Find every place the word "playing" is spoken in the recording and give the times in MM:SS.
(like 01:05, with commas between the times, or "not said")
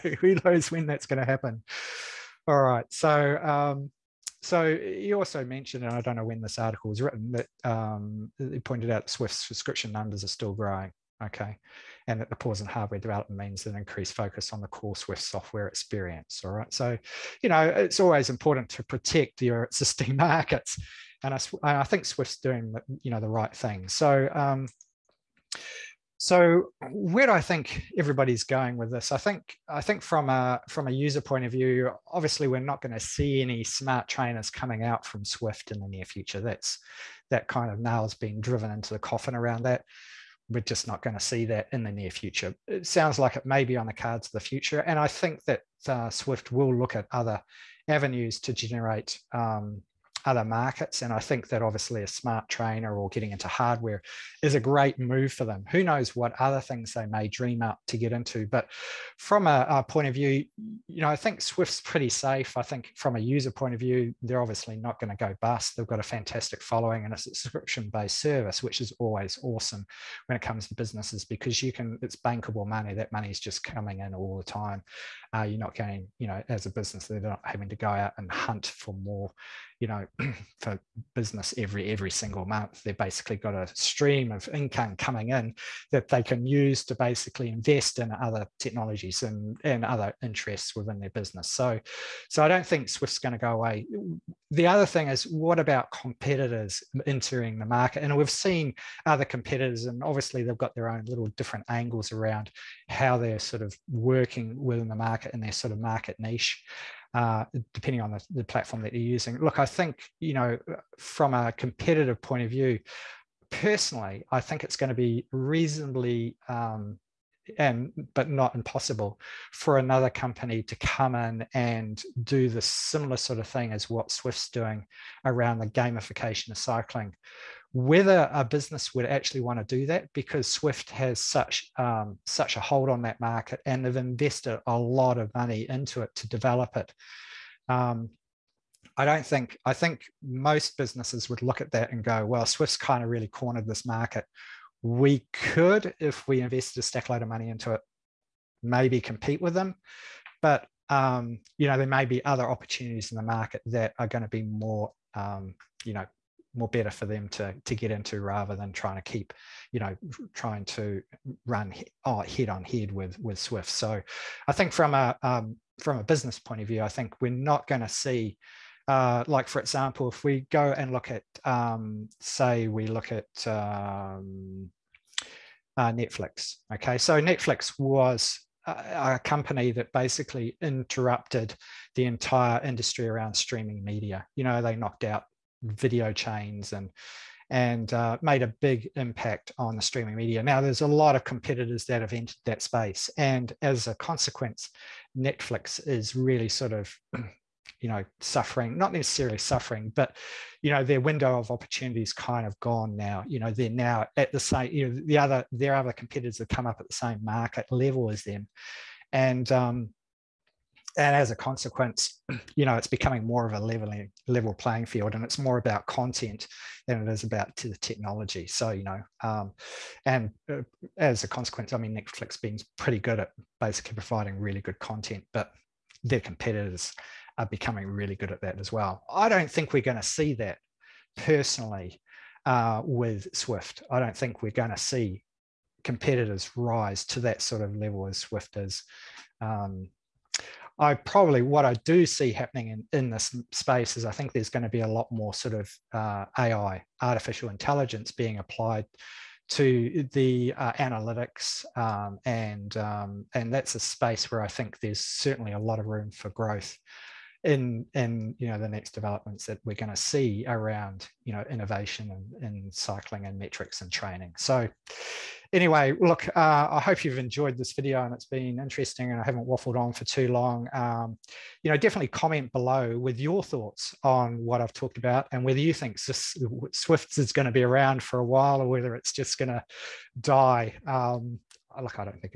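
03:34.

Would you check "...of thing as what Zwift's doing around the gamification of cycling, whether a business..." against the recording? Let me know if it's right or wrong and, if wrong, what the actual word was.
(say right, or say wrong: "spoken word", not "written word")
right.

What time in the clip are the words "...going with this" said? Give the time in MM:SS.
00:28.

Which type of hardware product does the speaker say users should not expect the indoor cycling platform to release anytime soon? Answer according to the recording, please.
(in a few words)
smart trainers.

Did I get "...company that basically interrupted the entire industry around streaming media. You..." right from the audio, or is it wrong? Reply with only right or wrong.
right.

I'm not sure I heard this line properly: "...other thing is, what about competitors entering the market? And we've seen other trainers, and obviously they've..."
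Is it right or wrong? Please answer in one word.
wrong.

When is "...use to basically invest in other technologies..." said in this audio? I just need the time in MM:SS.
01:26.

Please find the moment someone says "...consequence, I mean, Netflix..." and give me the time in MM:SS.
03:41.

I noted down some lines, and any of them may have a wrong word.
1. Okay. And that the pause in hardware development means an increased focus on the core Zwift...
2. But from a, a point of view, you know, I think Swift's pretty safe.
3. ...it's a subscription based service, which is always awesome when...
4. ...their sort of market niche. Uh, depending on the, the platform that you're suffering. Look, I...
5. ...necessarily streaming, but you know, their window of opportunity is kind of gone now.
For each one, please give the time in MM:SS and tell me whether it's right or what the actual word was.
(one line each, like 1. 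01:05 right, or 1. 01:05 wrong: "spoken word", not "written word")
1. 00:11 right
2. 00:58 wrong: "Zwift", not "Swift"
3. 01:07 right
4. 01:45 wrong: "using", not "suffering"
5. 03:18 wrong: "suffering", not "streaming".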